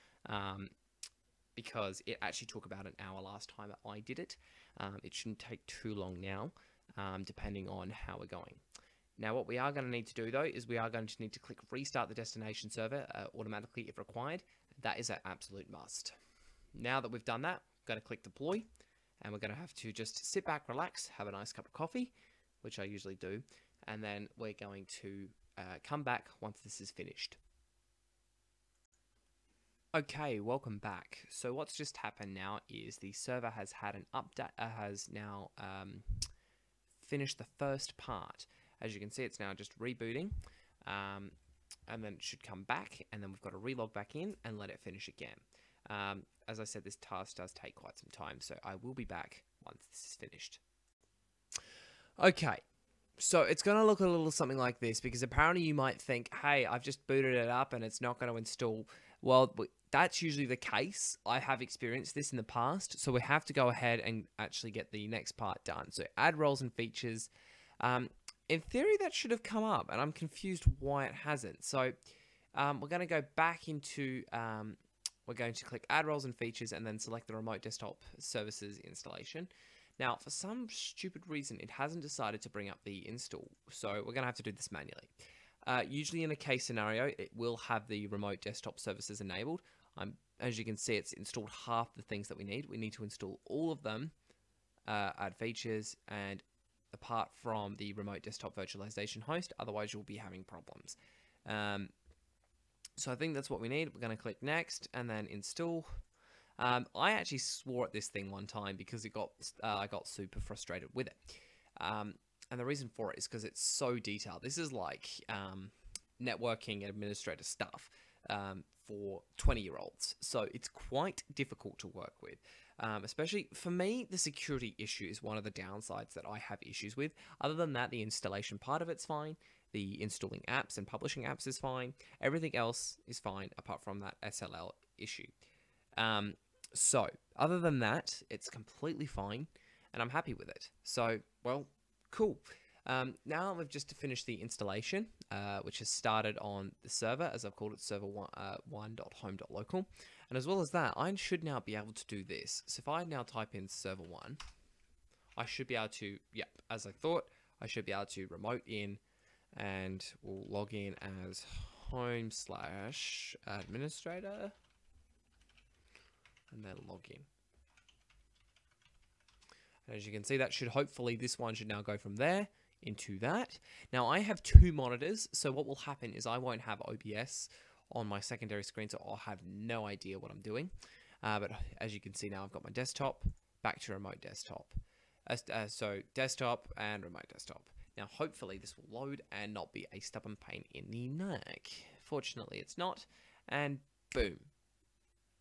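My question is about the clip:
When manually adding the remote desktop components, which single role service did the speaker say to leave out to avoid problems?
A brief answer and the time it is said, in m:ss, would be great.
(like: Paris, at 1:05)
Remote Desktop Virtualization Host, at 1:37.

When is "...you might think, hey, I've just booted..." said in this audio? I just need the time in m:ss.
0:55.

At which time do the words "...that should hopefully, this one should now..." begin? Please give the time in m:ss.
2:50.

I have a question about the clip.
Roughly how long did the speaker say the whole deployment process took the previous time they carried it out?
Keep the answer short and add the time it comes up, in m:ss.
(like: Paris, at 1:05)
About an hour, at 0:02.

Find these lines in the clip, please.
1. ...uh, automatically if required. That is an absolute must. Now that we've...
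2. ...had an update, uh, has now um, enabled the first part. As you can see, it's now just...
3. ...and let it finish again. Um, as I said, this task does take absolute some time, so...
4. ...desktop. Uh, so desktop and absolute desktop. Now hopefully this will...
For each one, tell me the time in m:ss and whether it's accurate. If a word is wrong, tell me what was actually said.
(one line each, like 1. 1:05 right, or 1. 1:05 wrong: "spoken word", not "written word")
1. 0:13 right
2. 0:33 wrong: "finished", not "enabled"
3. 0:44 wrong: "quite", not "absolute"
4. 3:04 wrong: "remote", not "absolute".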